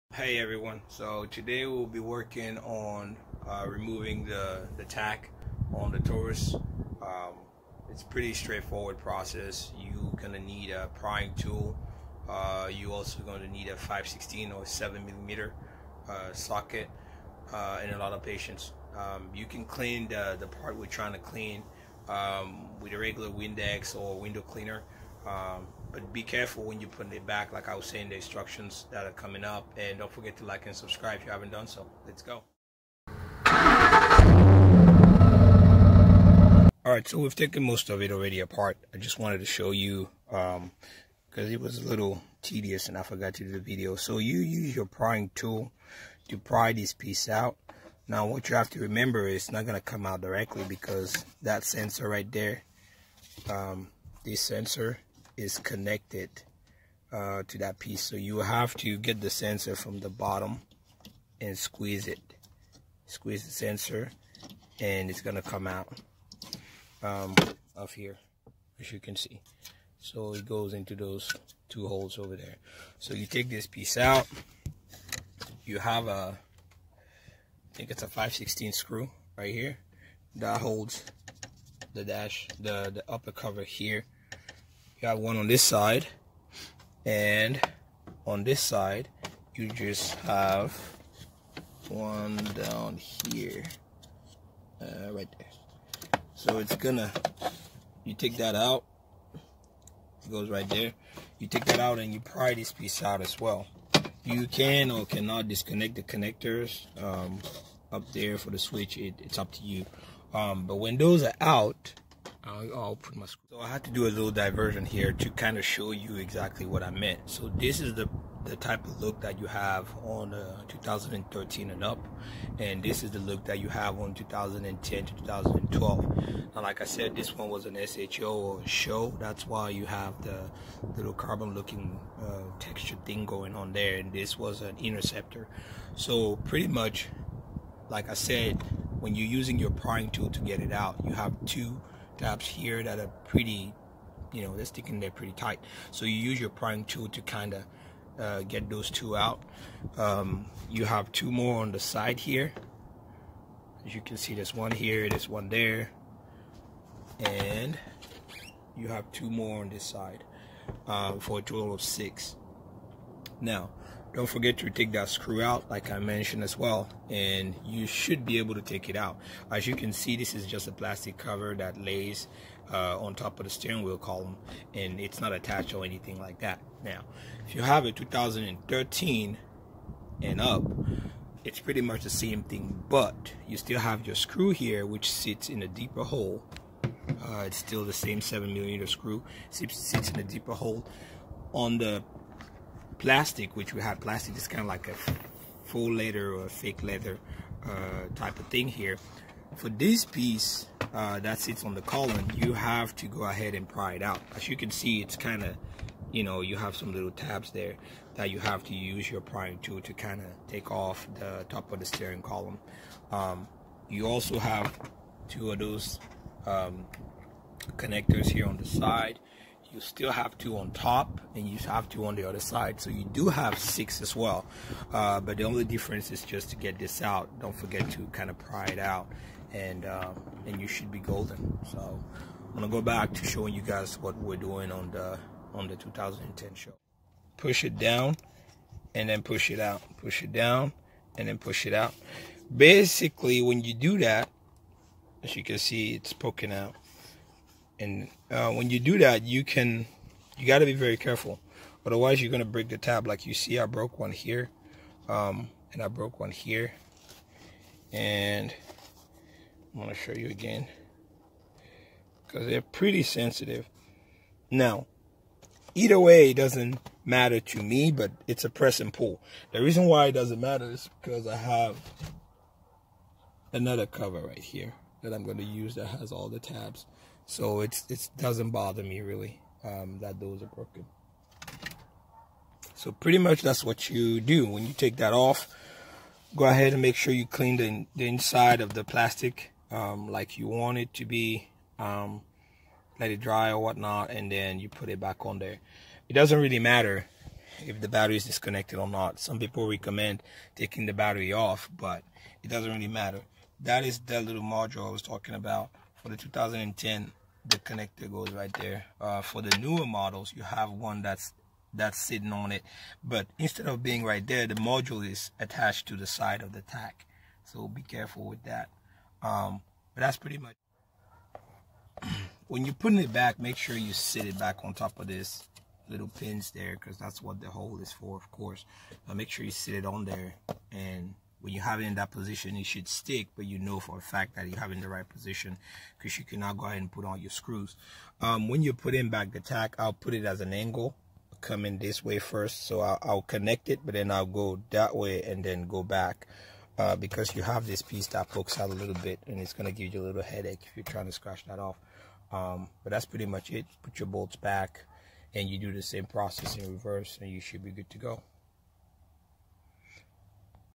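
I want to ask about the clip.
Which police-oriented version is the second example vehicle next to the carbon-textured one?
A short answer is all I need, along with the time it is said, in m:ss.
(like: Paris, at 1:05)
Interceptor, at 2:14.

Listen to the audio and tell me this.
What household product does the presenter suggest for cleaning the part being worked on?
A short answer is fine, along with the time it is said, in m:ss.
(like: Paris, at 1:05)
Windex, at 0:23.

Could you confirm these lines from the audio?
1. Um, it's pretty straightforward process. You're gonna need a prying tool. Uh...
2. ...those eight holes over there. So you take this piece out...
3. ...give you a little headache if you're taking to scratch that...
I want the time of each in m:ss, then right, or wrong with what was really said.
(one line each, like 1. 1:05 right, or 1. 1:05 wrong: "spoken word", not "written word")
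1. 0:07 right
2. 1:10 wrong: "two", not "eight"
3. 5:49 wrong: "trying", not "taking".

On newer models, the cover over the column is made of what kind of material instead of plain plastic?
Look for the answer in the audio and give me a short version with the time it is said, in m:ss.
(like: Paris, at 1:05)
fake leather, at 3:16.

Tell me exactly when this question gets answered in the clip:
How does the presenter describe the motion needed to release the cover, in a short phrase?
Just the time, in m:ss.
4:28.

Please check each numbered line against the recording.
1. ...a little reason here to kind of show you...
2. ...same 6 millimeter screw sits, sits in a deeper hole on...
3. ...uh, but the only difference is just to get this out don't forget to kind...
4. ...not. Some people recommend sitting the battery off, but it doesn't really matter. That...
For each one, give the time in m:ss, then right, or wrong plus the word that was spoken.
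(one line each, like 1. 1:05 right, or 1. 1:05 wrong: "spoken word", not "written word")
1. 1:54 wrong: "diversion", not "reason"
2. 3:07 wrong: "7", not "6"
3. 3:44 right
4. 4:58 wrong: "taking", not "sitting".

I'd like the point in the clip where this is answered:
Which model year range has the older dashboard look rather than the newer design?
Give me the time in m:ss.
2:04.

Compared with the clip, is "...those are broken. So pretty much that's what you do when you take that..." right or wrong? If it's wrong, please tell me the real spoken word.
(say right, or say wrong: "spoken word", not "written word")
right.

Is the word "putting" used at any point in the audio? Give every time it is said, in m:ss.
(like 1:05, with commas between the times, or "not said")
0:26, 5:22, 5:38.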